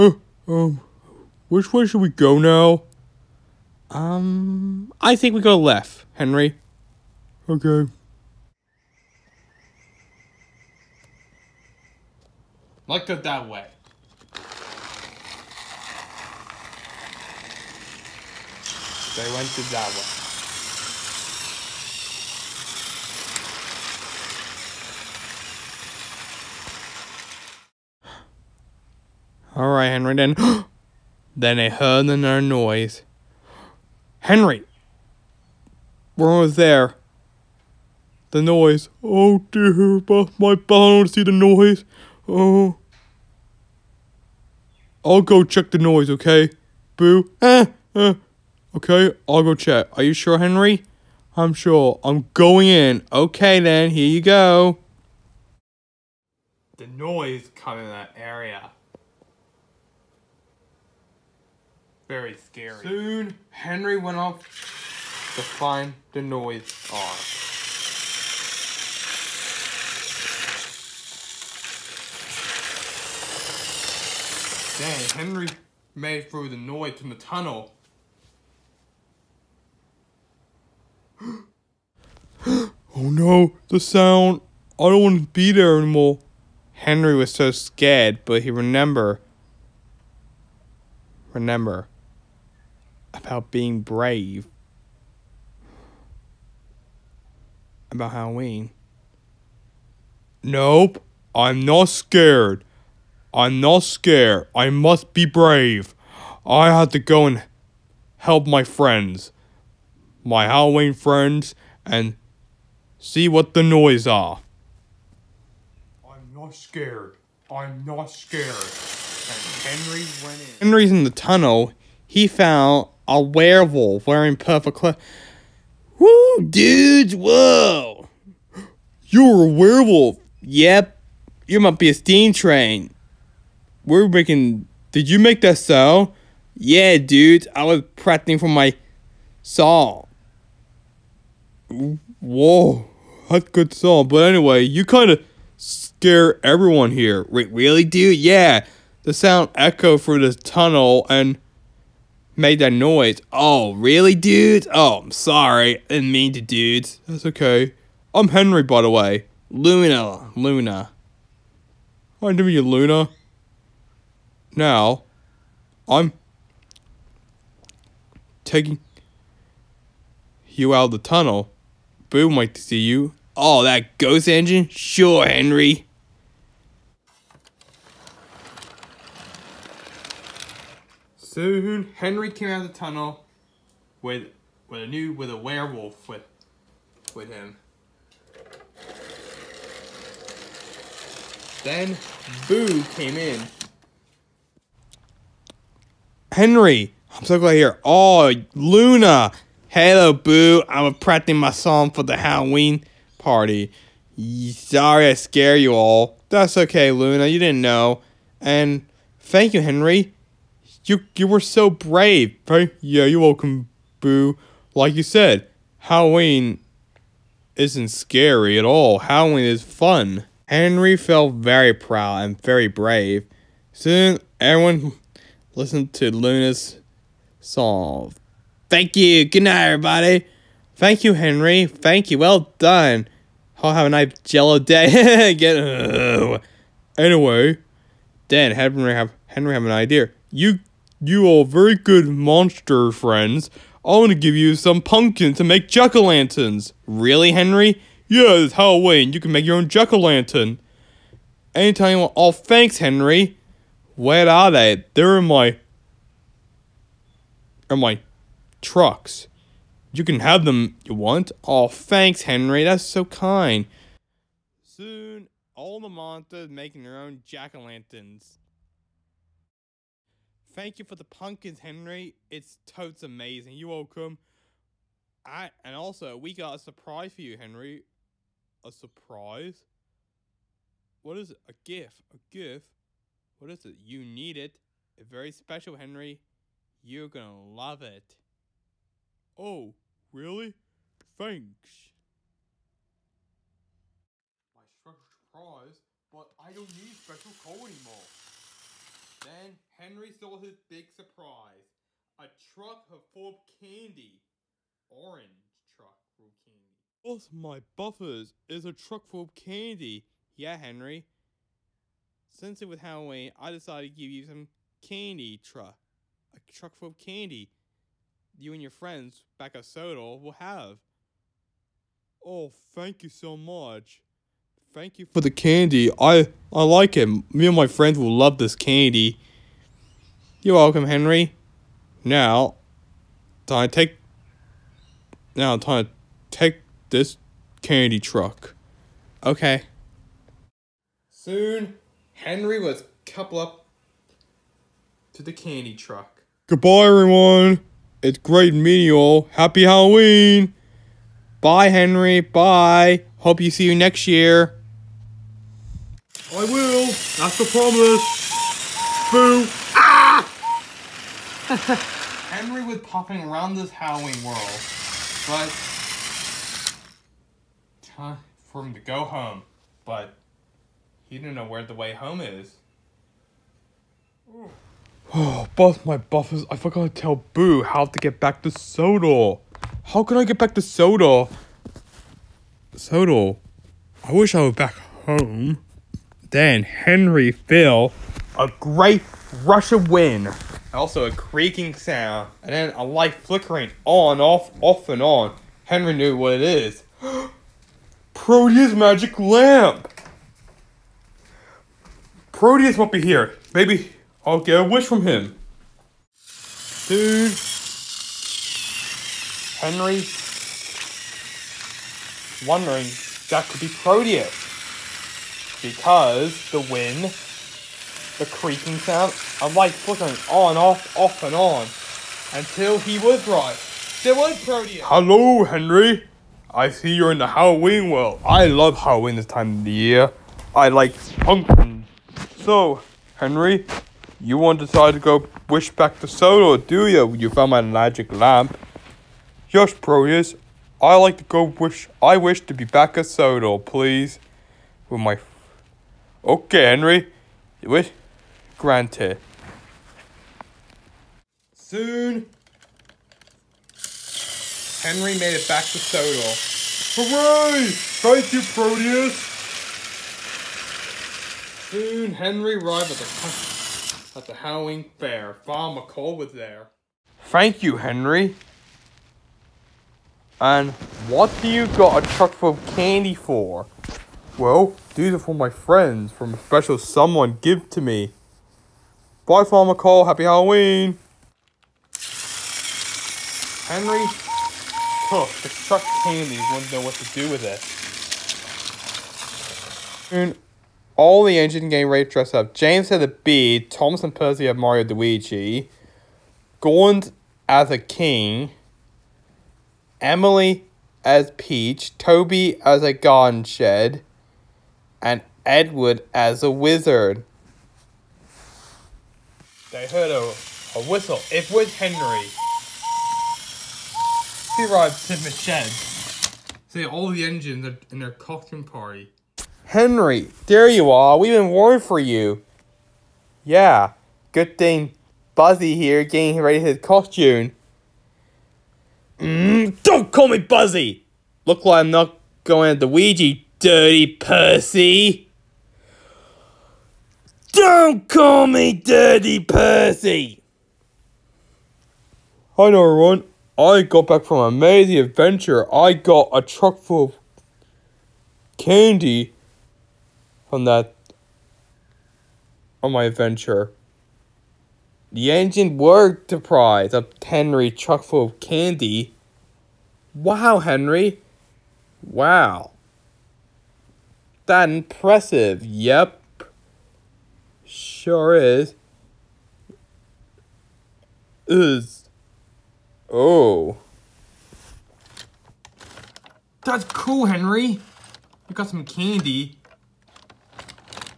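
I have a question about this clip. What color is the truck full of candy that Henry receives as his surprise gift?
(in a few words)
Orange.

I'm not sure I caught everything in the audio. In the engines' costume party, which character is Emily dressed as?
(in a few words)
Peach.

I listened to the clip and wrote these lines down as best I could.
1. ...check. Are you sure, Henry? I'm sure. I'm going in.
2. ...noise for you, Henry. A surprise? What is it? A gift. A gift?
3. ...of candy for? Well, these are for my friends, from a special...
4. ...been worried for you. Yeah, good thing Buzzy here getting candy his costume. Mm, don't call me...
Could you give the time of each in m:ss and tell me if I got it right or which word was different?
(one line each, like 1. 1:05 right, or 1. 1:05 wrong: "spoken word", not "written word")
1. 0:49 right
2. 4:36 wrong: "surprise", not "noise"
3. 7:52 right
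4. 8:41 wrong: "ready", not "candy".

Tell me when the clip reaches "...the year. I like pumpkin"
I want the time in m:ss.
7:09.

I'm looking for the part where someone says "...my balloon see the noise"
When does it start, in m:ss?
0:40.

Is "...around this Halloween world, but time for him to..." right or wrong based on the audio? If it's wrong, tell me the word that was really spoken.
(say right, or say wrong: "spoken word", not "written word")
right.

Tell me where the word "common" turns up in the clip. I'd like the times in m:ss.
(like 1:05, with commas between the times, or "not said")
not said.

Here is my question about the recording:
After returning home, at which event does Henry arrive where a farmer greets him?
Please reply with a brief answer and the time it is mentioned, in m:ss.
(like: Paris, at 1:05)
Howling Fair, at 7:44.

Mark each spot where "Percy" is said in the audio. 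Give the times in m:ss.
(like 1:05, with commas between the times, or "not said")
8:14, 8:54, 8:59.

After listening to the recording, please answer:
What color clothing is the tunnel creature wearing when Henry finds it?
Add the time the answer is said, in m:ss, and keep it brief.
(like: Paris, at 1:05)
Purple, at 2:04.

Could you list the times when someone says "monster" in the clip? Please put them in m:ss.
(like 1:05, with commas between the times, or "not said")
4:02, 4:25.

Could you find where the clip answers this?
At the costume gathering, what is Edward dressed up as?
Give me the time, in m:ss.
8:26.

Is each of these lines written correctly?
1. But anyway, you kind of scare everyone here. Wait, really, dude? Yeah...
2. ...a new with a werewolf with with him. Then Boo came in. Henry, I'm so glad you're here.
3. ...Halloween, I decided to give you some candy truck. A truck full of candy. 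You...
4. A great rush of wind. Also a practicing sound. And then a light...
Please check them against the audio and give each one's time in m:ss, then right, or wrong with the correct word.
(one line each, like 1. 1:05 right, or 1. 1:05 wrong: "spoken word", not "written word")
1. 2:24 right
2. 3:04 right
3. 5:12 right
4. 6:28 wrong: "creaking", not "practicing".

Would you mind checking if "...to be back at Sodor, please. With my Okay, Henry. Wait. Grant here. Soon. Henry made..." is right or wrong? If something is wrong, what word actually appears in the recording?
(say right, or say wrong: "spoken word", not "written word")
right.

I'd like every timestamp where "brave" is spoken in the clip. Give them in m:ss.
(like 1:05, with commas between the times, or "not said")
1:33, 1:45, 3:31, 3:42.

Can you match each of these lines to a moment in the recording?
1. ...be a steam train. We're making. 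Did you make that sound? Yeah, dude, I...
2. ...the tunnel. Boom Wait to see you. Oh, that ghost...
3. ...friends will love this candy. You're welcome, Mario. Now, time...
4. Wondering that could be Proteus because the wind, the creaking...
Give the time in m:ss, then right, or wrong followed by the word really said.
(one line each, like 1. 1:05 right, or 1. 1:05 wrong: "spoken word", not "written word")
1. 2:11 right
2. 2:50 right
3. 5:27 wrong: "Henry", not "Mario"
4. 6:52 right.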